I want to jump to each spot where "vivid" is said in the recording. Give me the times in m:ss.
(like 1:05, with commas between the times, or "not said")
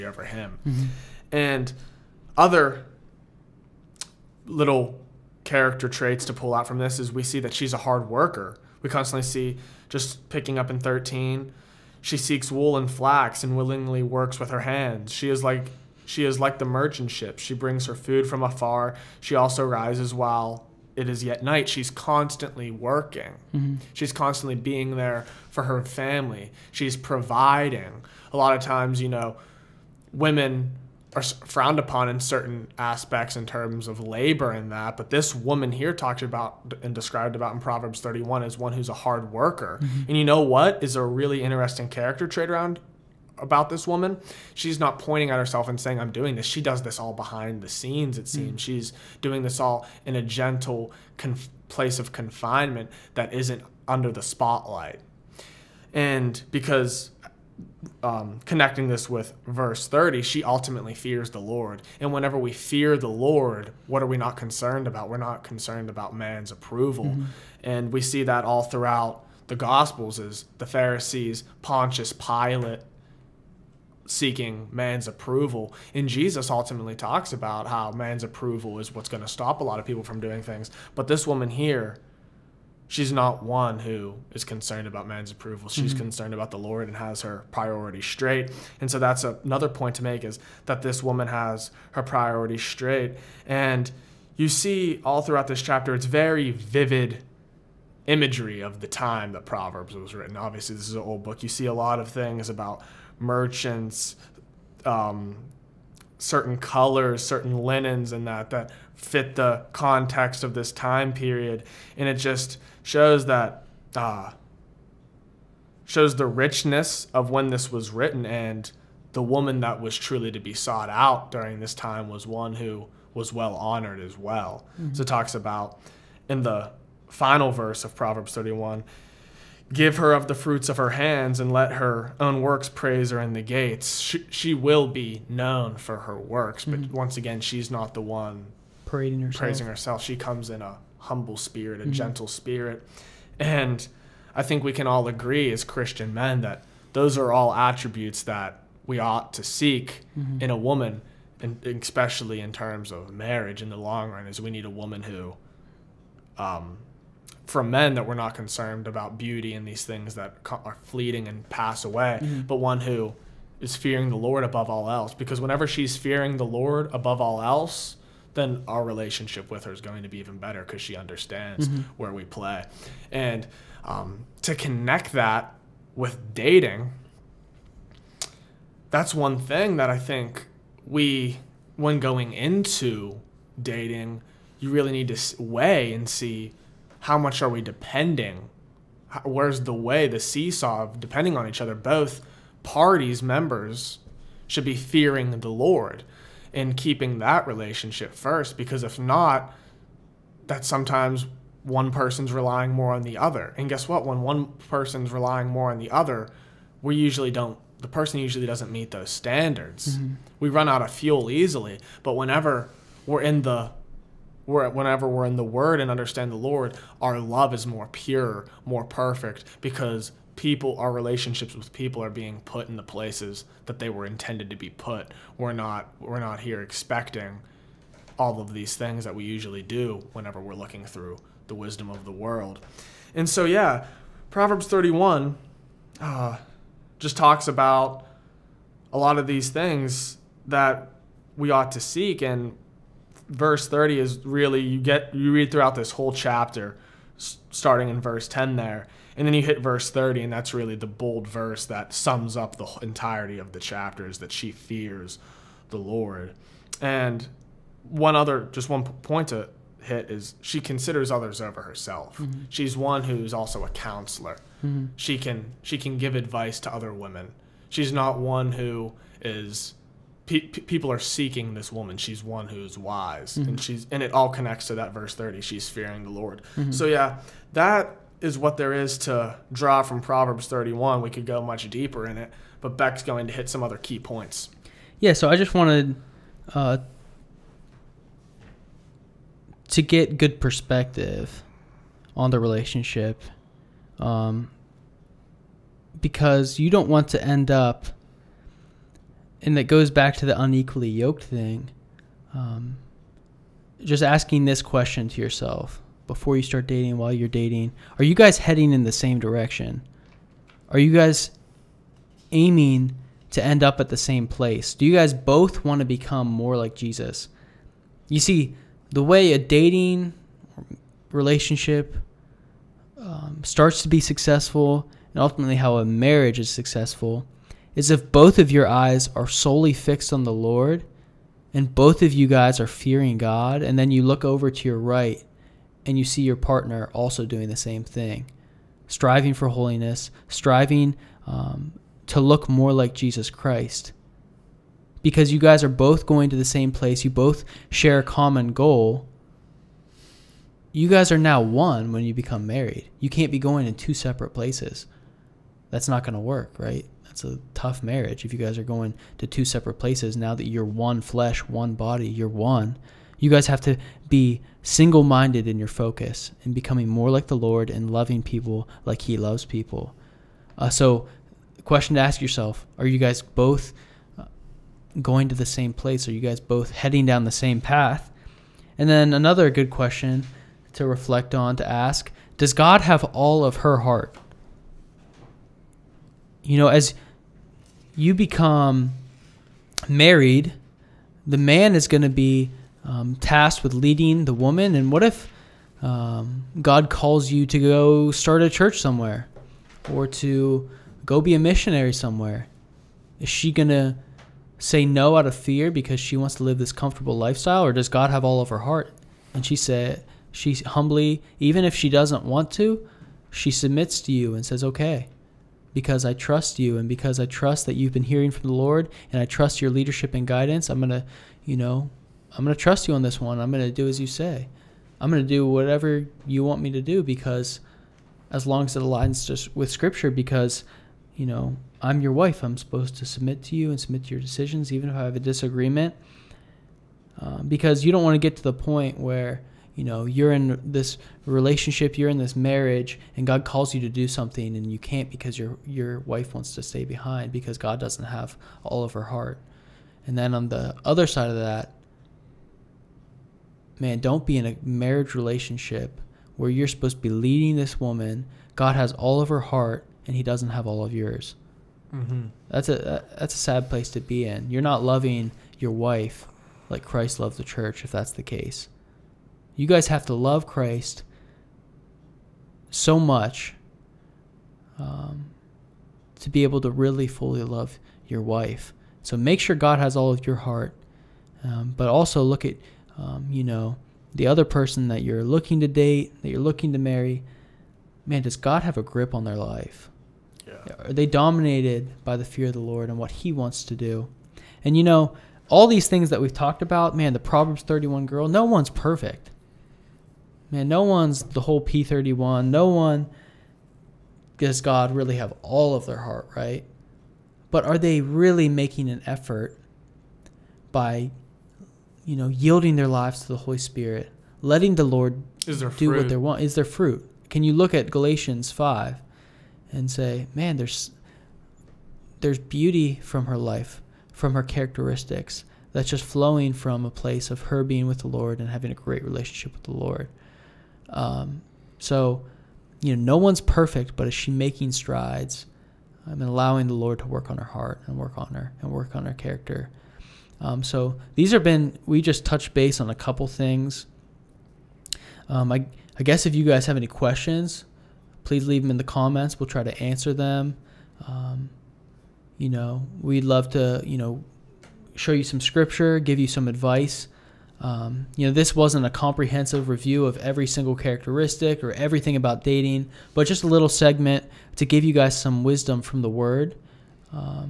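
1:36.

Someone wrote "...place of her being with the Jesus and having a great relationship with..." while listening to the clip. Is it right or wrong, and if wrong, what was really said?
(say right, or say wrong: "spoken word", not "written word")
wrong: "Lord", not "Jesus".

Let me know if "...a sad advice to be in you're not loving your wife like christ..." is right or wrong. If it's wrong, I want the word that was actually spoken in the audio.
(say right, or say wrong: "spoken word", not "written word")
wrong: "place", not "advice".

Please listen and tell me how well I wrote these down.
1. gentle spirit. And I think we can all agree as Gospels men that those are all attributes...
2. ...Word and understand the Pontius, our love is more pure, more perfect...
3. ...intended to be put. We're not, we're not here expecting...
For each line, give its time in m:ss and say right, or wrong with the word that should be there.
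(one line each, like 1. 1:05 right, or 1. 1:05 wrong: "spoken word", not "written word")
1. 2:21 wrong: "Christian", not "Gospels"
2. 3:35 wrong: "Lord", not "Pontius"
3. 3:44 right.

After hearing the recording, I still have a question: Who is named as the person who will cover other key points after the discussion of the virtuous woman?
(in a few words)
Beck.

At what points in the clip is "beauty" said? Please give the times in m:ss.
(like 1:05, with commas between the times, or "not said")
2:39, 8:42.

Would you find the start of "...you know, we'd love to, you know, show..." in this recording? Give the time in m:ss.
9:12.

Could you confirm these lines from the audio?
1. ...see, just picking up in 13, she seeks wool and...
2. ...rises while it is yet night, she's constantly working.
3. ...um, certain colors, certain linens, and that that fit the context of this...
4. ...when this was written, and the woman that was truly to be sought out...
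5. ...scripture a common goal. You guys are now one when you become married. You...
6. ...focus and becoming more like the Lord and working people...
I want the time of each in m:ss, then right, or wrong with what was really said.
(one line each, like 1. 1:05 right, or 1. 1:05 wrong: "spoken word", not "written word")
1. 0:09 right
2. 0:19 right
3. 1:44 right
4. 1:57 right
5. 5:47 wrong: "share", not "scripture"
6. 6:05 wrong: "loving", not "working".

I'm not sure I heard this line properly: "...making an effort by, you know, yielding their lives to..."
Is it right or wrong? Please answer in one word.
right.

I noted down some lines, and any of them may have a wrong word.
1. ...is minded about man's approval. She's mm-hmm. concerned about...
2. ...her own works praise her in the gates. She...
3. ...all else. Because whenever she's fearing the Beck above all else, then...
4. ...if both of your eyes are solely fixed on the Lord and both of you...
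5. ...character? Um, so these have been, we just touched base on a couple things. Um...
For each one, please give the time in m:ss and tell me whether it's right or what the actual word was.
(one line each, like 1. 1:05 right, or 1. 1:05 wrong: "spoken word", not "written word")
1. 1:24 wrong: "concerned", not "minded"
2. 2:11 right
3. 2:44 wrong: "Lord", not "Beck"
4. 5:27 right
5. 8:59 right.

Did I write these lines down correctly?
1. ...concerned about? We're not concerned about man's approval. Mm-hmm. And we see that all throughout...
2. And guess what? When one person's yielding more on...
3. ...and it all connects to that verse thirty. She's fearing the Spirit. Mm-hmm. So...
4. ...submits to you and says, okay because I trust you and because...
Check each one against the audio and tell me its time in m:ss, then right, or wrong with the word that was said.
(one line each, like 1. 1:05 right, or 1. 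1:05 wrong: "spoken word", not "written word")
1. 1:04 right
2. 3:23 wrong: "relying", not "yielding"
3. 4:33 wrong: "Lord", not "Spirit"
4. 6:53 right.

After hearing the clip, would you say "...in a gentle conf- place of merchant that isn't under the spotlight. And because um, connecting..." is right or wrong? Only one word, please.
wrong.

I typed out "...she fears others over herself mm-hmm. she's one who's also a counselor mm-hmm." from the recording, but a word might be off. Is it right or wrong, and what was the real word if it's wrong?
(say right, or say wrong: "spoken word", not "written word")
wrong: "considers", not "fears".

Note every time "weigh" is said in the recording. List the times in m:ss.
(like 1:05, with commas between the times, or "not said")
3:05.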